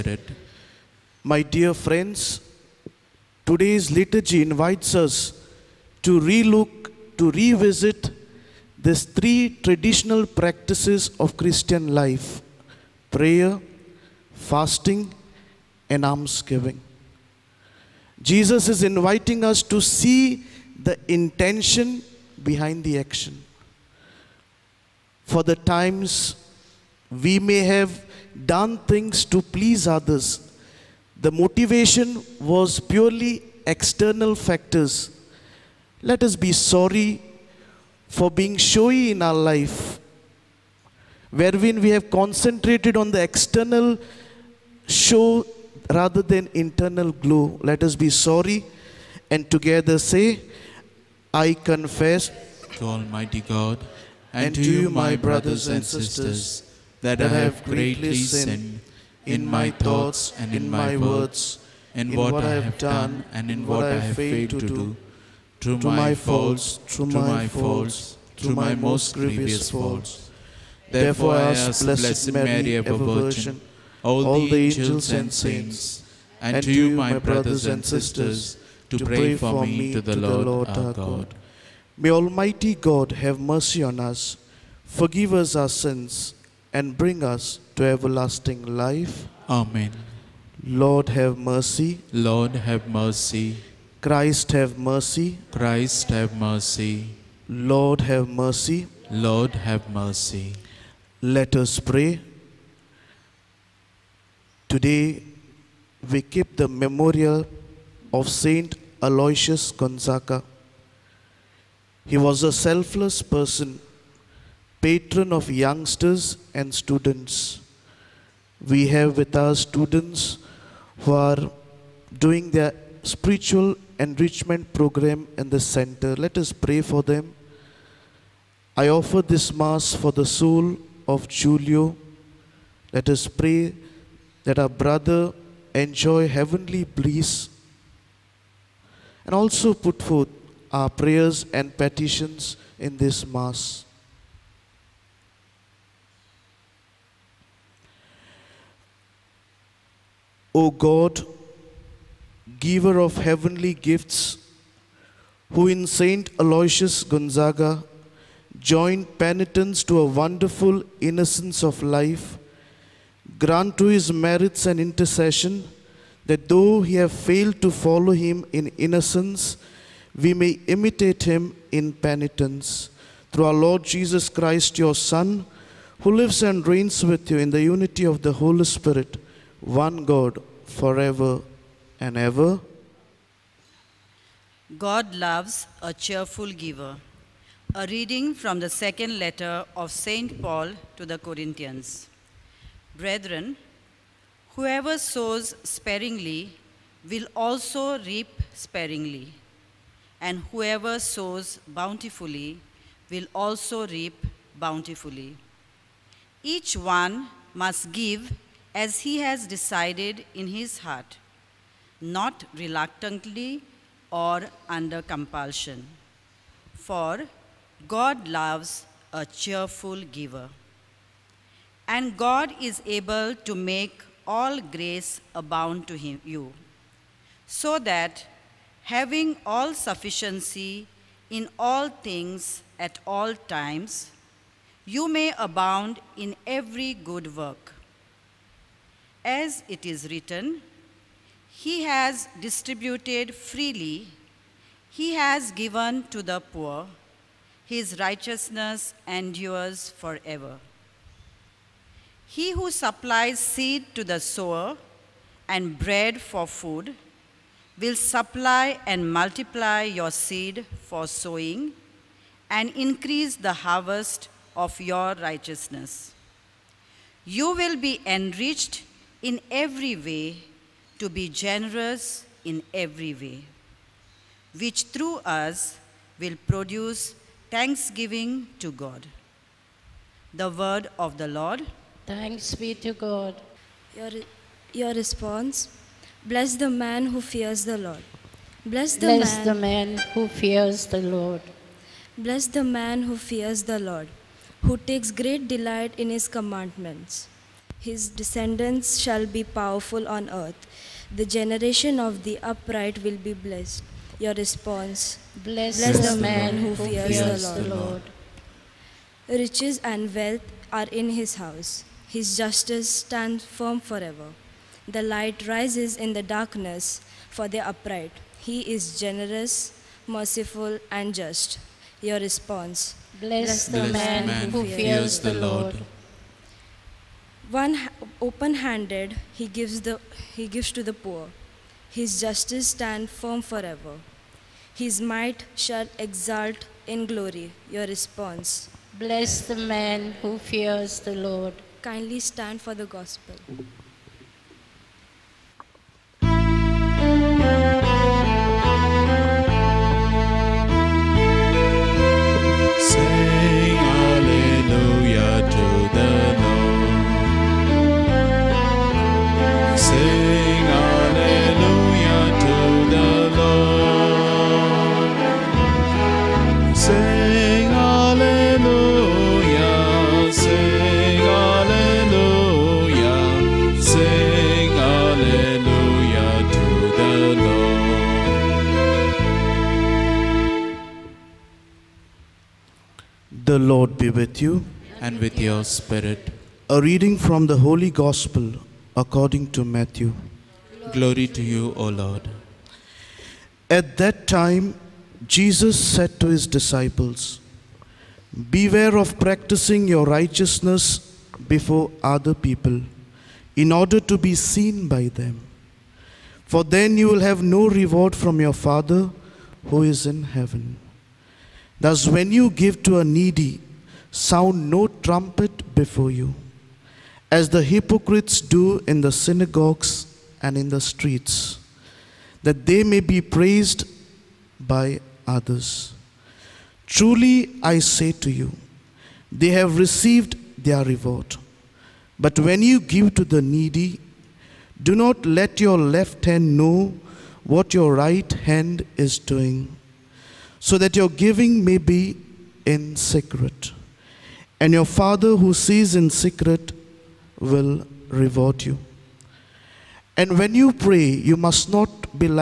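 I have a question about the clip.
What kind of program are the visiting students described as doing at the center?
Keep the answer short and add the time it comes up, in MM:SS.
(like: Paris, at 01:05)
spiritual enrichment program, at 02:03.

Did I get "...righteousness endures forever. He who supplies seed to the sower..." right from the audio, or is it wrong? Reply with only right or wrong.
right.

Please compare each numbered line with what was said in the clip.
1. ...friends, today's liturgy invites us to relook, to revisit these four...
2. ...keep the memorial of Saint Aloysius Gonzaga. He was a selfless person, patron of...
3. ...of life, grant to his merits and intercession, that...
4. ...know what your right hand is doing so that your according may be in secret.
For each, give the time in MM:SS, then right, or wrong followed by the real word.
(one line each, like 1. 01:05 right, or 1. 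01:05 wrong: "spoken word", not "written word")
1. 00:01 wrong: "three", not "four"
2. 01:46 right
3. 02:41 right
4. 07:16 wrong: "giving", not "according".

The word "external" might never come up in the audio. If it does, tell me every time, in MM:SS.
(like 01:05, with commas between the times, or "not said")
00:33, 00:43.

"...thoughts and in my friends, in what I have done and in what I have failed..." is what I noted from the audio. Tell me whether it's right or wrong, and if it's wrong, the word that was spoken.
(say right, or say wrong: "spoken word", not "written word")
wrong: "words", not "friends".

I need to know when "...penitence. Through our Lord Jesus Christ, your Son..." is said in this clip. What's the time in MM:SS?
02:51.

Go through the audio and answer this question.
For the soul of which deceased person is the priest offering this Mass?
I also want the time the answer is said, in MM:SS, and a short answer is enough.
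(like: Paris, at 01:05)
Julio, at 02:11.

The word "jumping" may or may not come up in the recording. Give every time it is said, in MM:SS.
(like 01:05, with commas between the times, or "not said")
not said.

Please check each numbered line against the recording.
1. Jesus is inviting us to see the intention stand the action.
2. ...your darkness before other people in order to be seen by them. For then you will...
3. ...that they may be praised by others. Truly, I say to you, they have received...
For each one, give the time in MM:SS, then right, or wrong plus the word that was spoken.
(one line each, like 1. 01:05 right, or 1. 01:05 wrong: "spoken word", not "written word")
1. 00:18 wrong: "behind", not "stand"
2. 06:39 wrong: "righteousness", not "darkness"
3. 07:02 right.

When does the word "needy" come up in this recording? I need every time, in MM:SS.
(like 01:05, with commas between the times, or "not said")
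06:53, 07:13.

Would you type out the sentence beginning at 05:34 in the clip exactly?
His might shall exalt in glory.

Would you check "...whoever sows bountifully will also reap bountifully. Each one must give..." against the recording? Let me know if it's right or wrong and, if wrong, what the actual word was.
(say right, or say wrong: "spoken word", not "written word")
right.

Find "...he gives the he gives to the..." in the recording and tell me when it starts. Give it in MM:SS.
05:29.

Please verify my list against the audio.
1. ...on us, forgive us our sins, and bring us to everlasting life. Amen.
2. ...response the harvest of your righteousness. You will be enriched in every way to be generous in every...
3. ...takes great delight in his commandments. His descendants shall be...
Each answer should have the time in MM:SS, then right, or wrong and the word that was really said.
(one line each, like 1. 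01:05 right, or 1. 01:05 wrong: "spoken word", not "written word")
1. 01:23 right
2. 04:22 wrong: "increase", not "response"
3. 04:54 right.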